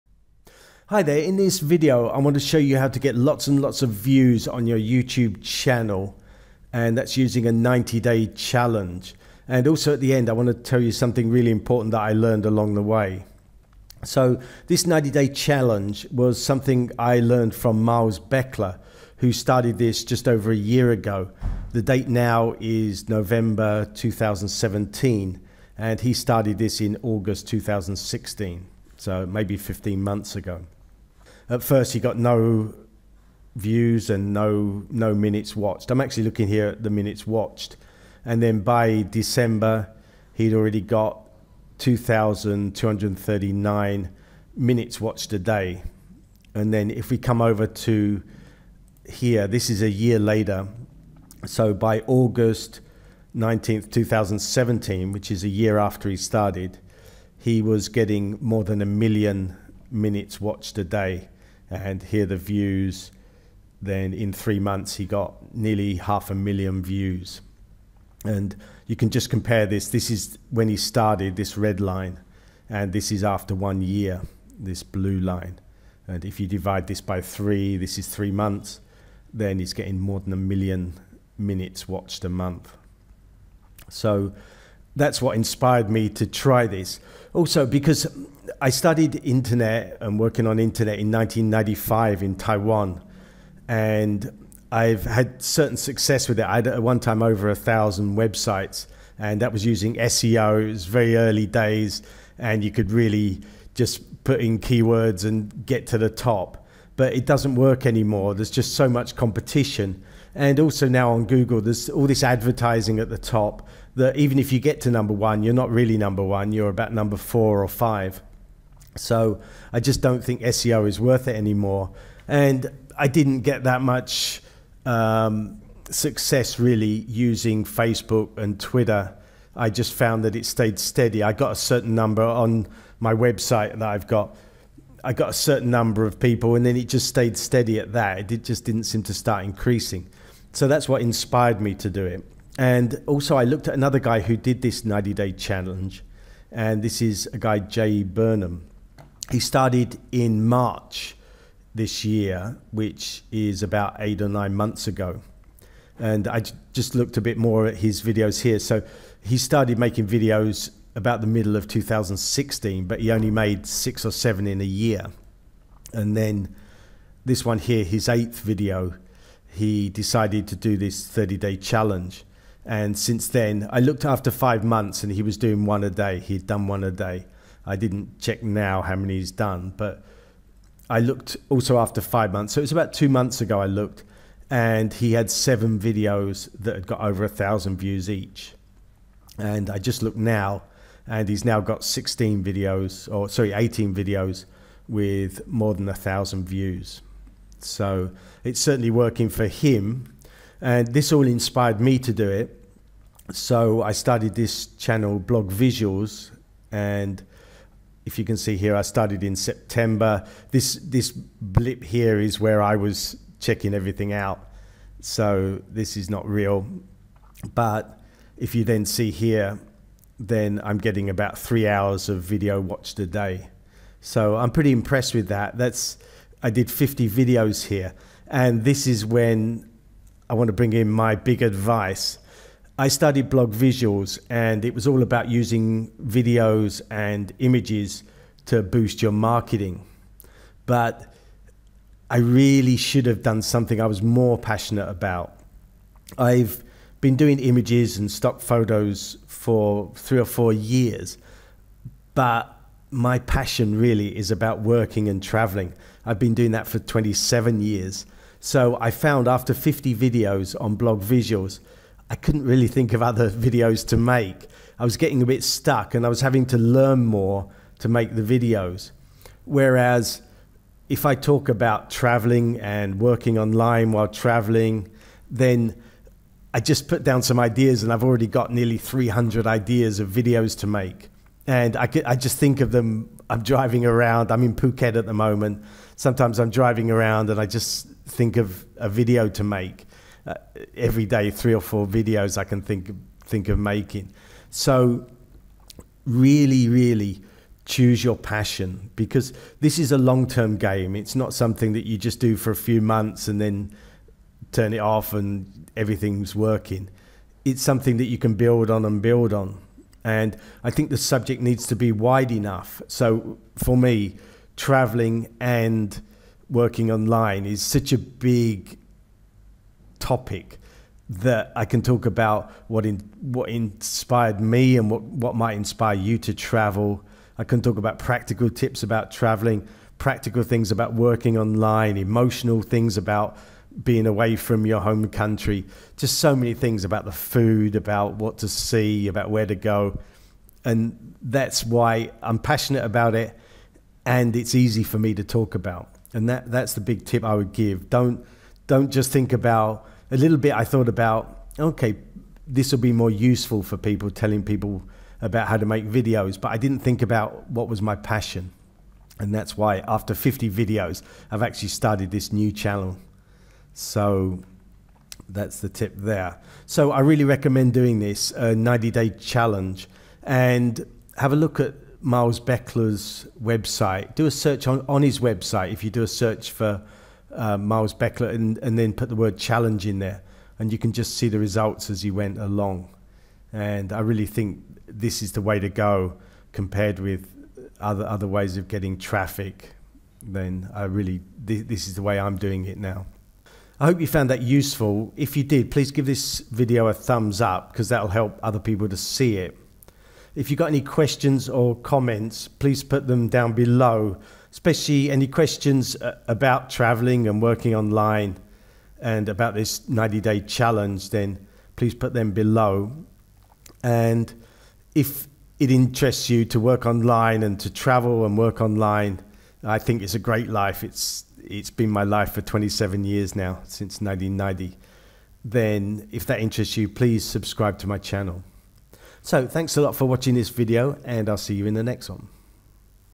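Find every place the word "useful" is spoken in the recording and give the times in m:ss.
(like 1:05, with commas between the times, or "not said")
5:53, 6:34.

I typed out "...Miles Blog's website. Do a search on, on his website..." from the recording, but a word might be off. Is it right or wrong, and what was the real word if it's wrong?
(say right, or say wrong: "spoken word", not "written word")
wrong: "Beckler", not "Blog".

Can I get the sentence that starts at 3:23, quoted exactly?
So I started this channel, Blog Visuals, and if you can see here, I started in September.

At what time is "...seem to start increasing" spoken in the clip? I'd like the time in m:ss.
2:18.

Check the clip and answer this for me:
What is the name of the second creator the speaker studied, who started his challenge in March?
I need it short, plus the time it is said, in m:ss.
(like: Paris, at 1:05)
Jay Burnham, at 2:27.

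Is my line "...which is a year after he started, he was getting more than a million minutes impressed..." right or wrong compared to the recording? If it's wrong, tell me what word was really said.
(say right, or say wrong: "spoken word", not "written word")
wrong: "watched", not "impressed".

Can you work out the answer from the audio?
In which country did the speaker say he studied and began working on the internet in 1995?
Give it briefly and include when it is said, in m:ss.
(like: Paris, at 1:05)
Taiwan, at 1:32.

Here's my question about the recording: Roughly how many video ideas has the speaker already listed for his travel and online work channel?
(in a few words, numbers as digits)
nearly 300.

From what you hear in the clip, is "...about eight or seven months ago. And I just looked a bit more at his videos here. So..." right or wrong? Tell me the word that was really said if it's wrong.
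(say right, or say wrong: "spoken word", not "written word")
wrong: "nine", not "seven".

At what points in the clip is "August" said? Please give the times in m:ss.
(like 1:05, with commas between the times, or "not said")
0:27, 0:52.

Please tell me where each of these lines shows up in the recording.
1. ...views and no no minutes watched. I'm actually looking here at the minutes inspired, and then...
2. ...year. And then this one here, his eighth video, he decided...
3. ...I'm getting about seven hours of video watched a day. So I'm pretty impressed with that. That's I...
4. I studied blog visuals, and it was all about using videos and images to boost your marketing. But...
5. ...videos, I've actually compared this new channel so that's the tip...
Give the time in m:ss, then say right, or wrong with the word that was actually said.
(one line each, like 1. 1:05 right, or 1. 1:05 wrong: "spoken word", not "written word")
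1. 0:33 wrong: "watched", not "inspired"
2. 2:44 right
3. 3:40 wrong: "three", not "seven"
4. 3:52 right
5. 6:00 wrong: "started", not "compared".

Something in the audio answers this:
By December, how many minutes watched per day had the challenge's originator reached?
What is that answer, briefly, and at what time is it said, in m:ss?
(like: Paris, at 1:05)
2,239, at 0:41.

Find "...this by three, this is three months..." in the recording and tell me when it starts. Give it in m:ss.
1:16.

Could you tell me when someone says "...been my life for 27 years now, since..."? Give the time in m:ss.
7:01.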